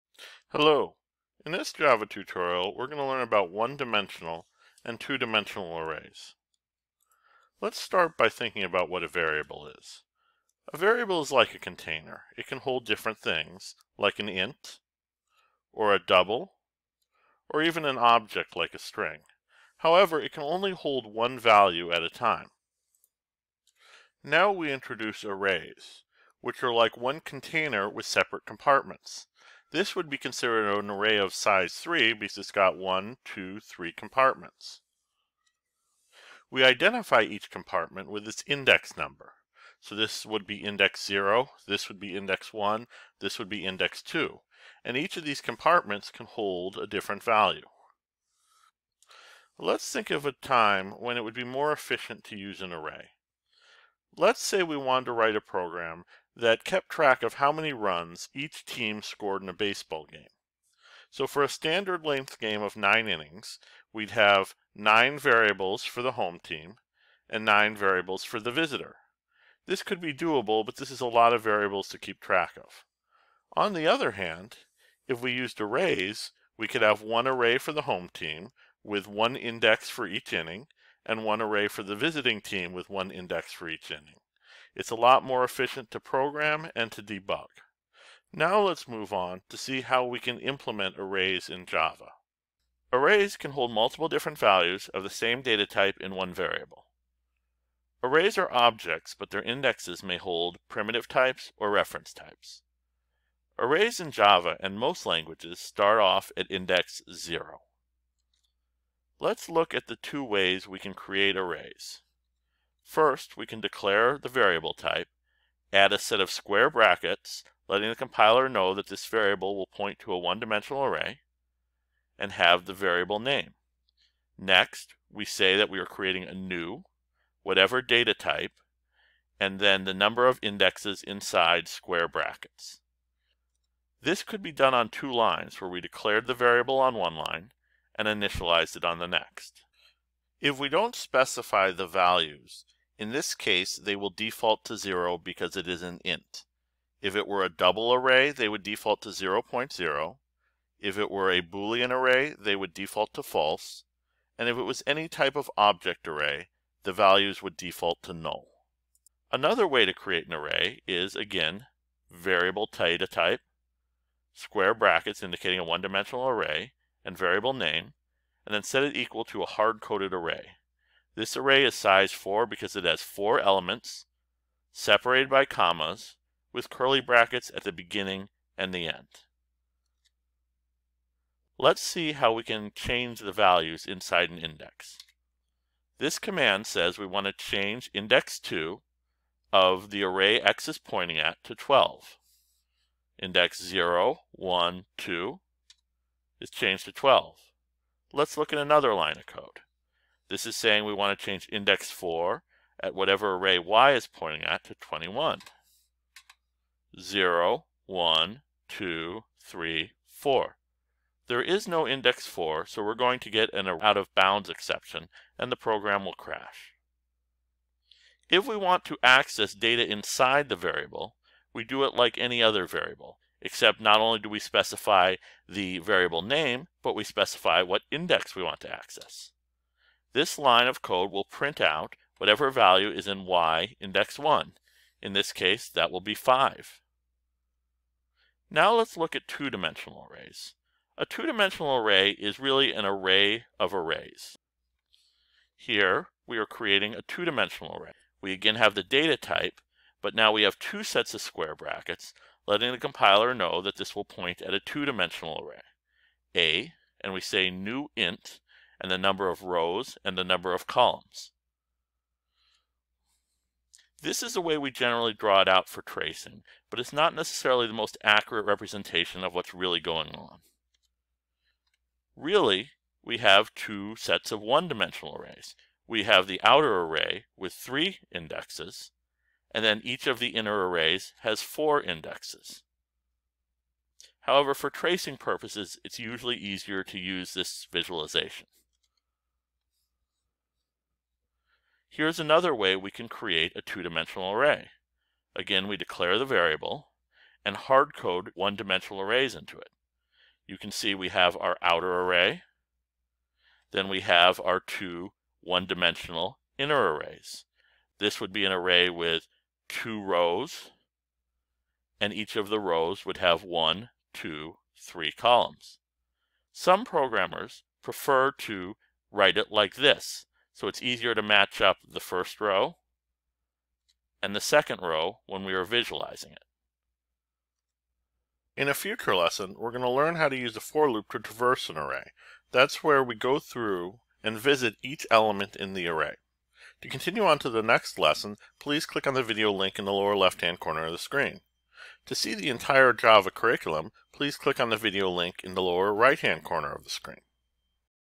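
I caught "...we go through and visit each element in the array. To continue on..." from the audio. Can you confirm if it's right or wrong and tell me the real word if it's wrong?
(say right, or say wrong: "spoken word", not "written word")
right.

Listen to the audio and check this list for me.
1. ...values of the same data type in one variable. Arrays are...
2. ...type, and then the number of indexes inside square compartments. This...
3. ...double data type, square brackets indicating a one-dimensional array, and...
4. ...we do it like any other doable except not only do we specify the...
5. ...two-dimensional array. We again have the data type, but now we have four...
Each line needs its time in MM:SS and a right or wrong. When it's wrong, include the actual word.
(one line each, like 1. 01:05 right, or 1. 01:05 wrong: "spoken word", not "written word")
1. 01:34 right
2. 02:08 wrong: "brackets", not "compartments"
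3. 02:42 wrong: "variable", not "double"
4. 03:41 wrong: "variable", not "doable"
5. 04:07 wrong: "two", not "four".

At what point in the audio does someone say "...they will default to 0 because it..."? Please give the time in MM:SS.
02:23.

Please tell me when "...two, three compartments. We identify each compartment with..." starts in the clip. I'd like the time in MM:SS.
00:33.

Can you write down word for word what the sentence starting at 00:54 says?
Let's say we wanted to write a program that kept track of how many runs each team scored in a baseball game.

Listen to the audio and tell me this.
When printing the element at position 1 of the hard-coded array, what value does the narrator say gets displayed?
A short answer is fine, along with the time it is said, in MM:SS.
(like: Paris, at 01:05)
5, at 03:56.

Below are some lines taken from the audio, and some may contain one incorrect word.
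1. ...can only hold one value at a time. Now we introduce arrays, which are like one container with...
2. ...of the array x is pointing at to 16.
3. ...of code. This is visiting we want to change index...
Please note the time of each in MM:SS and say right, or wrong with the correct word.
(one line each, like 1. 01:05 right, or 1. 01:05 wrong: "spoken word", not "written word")
1. 00:20 right
2. 03:09 wrong: "12", not "16"
3. 03:19 wrong: "saying", not "visiting".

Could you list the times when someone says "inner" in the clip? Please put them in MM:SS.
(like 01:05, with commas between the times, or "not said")
04:40, 05:06.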